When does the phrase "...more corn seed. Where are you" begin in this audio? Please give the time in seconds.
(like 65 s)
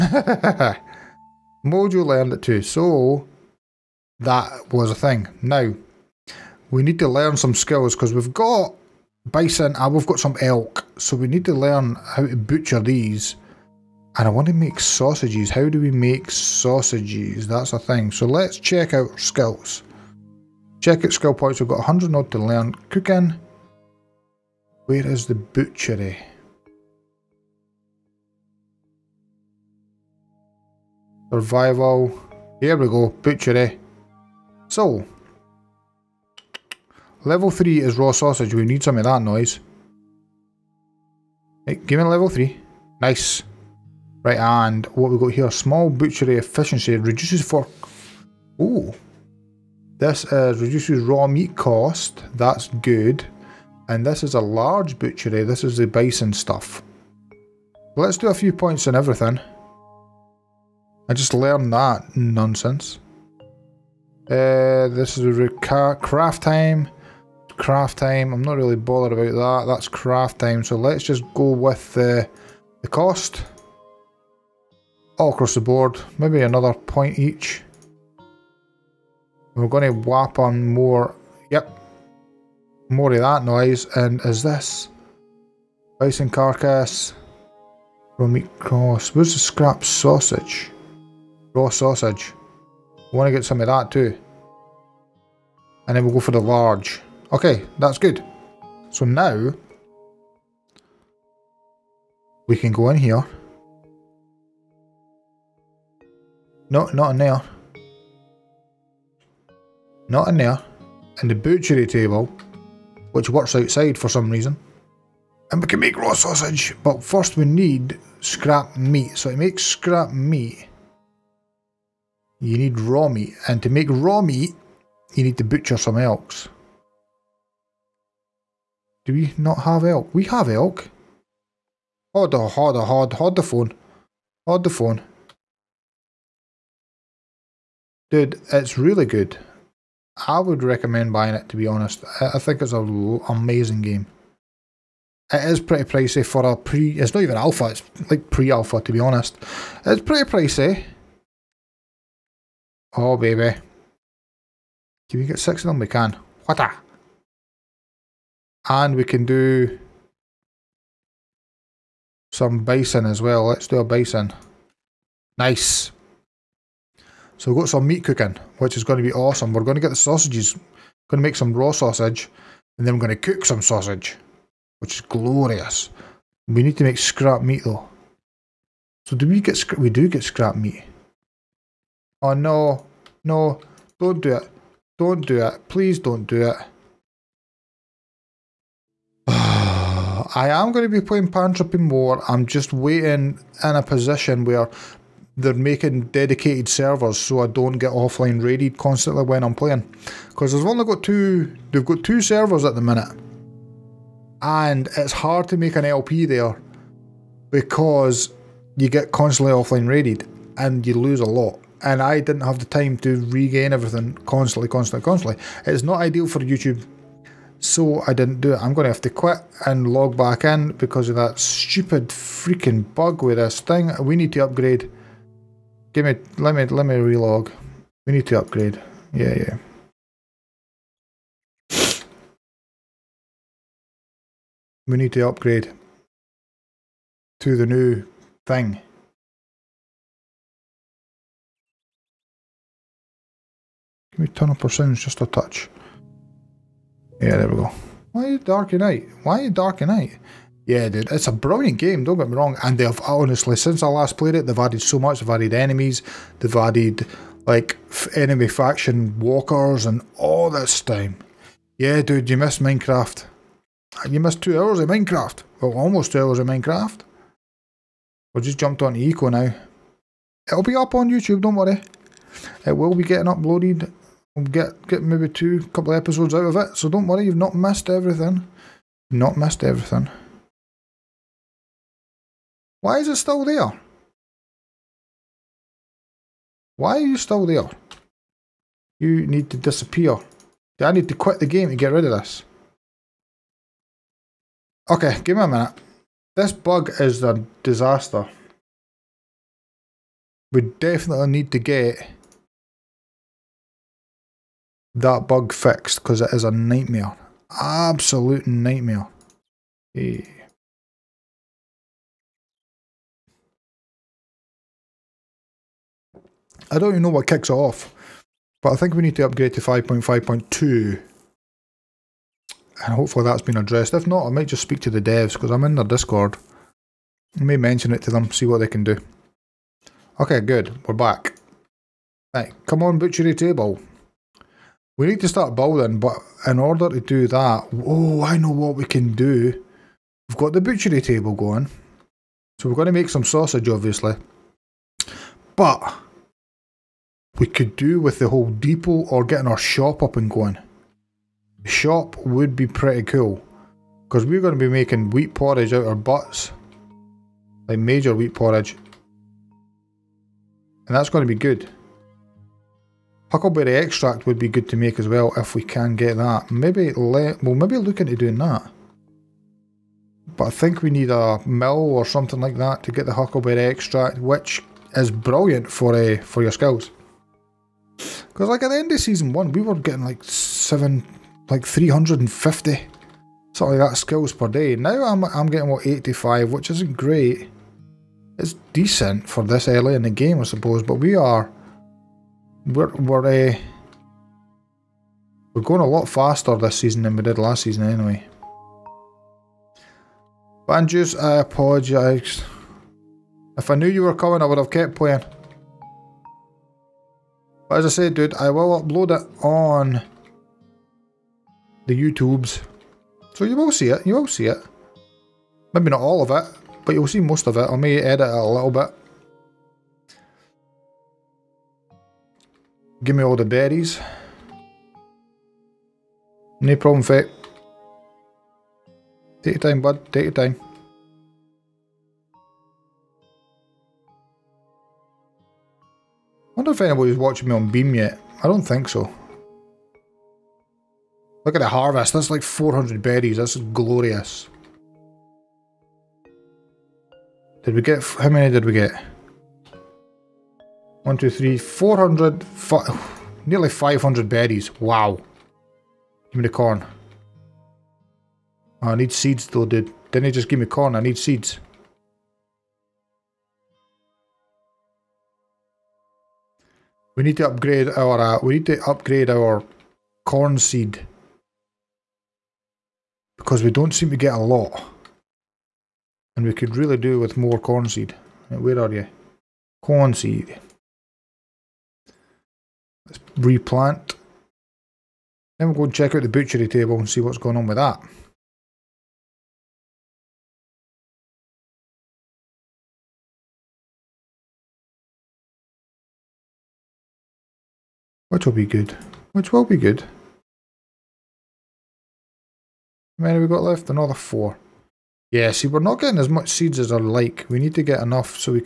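477 s.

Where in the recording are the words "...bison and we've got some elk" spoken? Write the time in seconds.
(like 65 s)
9 s.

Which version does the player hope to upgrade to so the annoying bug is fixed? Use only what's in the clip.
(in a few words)
5.5.2.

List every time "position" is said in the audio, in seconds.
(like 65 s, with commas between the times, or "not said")
193 s.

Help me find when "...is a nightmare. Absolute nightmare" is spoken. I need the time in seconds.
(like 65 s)
306 s.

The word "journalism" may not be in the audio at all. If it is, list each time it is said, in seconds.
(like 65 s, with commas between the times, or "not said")
not said.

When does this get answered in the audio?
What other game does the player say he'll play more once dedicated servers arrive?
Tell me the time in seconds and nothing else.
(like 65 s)
191 s.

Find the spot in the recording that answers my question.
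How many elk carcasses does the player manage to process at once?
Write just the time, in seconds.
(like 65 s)
155 s.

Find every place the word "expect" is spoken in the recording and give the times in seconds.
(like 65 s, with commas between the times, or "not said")
not said.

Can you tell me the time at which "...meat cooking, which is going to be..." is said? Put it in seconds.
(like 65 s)
167 s.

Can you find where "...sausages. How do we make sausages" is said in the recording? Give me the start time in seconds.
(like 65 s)
14 s.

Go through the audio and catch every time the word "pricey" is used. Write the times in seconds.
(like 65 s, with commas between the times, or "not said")
145 s, 150 s.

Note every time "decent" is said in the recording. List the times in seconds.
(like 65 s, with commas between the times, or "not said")
388 s.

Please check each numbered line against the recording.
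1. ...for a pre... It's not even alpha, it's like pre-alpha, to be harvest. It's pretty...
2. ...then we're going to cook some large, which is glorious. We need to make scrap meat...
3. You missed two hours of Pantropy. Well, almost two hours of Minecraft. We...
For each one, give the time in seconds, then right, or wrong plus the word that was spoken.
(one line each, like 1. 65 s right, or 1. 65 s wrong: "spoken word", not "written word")
1. 146 s wrong: "honest", not "harvest"
2. 172 s wrong: "sausage", not "large"
3. 264 s wrong: "Minecraft", not "Pantropy".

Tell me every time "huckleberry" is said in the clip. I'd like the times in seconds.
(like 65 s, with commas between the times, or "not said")
363 s, 373 s.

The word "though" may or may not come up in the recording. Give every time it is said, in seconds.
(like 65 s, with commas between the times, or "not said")
177 s, 459 s.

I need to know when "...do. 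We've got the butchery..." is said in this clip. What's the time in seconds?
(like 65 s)
339 s.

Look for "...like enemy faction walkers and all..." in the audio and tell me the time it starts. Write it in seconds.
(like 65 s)
257 s.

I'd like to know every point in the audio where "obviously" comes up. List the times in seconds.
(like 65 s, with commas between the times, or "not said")
343 s.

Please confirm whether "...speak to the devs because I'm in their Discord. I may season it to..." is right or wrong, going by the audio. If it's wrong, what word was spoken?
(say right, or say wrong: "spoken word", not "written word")
wrong: "mention", not "season".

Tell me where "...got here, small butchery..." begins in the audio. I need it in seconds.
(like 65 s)
45 s.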